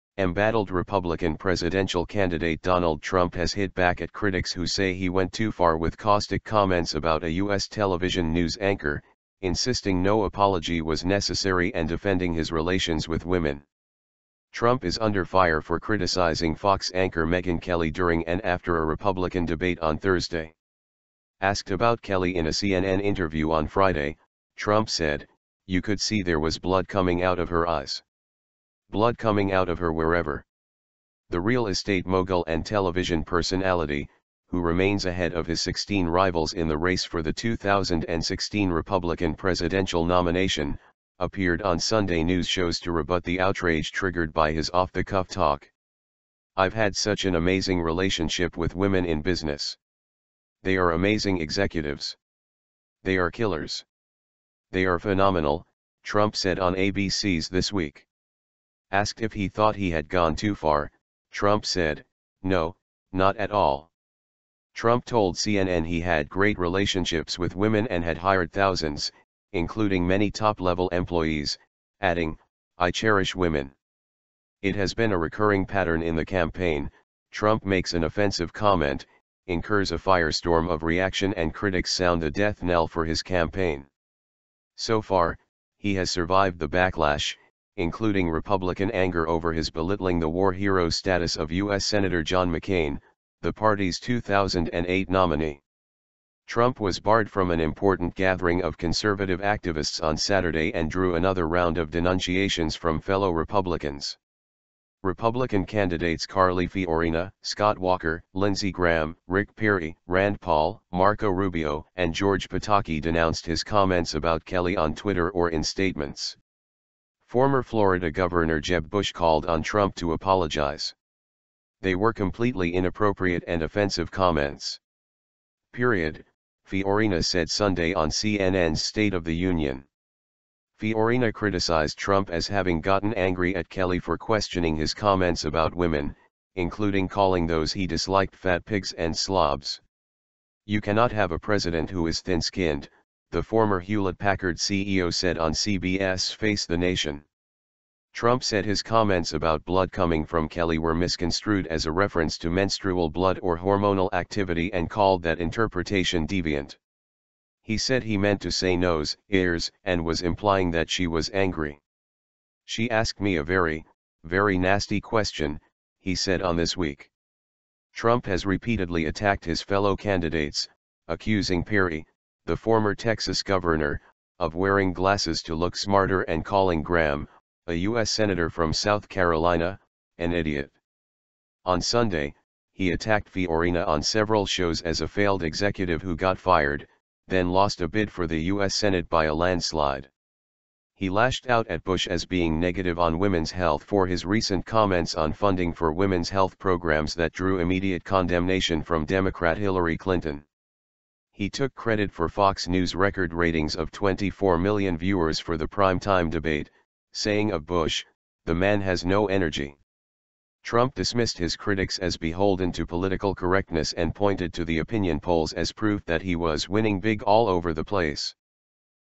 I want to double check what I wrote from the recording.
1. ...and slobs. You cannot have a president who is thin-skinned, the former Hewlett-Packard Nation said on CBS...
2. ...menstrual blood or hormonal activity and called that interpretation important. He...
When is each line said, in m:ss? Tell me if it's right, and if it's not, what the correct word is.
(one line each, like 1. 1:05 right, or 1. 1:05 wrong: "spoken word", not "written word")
1. 2:18 wrong: "CEO", not "Nation"
2. 2:32 wrong: "deviant", not "important".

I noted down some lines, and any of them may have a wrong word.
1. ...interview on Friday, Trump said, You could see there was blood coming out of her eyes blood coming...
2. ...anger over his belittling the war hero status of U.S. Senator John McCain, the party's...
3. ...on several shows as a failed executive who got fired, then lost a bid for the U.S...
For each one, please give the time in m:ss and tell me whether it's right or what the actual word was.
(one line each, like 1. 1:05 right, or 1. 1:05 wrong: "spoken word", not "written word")
1. 0:23 right
2. 1:28 right
3. 3:03 right.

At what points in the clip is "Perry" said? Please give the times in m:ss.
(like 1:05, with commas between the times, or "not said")
1:49, 2:51.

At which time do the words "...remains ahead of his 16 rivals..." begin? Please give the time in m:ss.
0:34.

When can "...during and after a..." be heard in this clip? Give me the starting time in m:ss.
0:17.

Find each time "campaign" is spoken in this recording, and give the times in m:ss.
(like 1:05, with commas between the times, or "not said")
1:16, 1:23.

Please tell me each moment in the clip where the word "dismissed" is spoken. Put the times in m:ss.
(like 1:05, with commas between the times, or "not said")
3:30.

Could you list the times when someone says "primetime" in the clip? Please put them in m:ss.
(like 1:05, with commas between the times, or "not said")
3:25.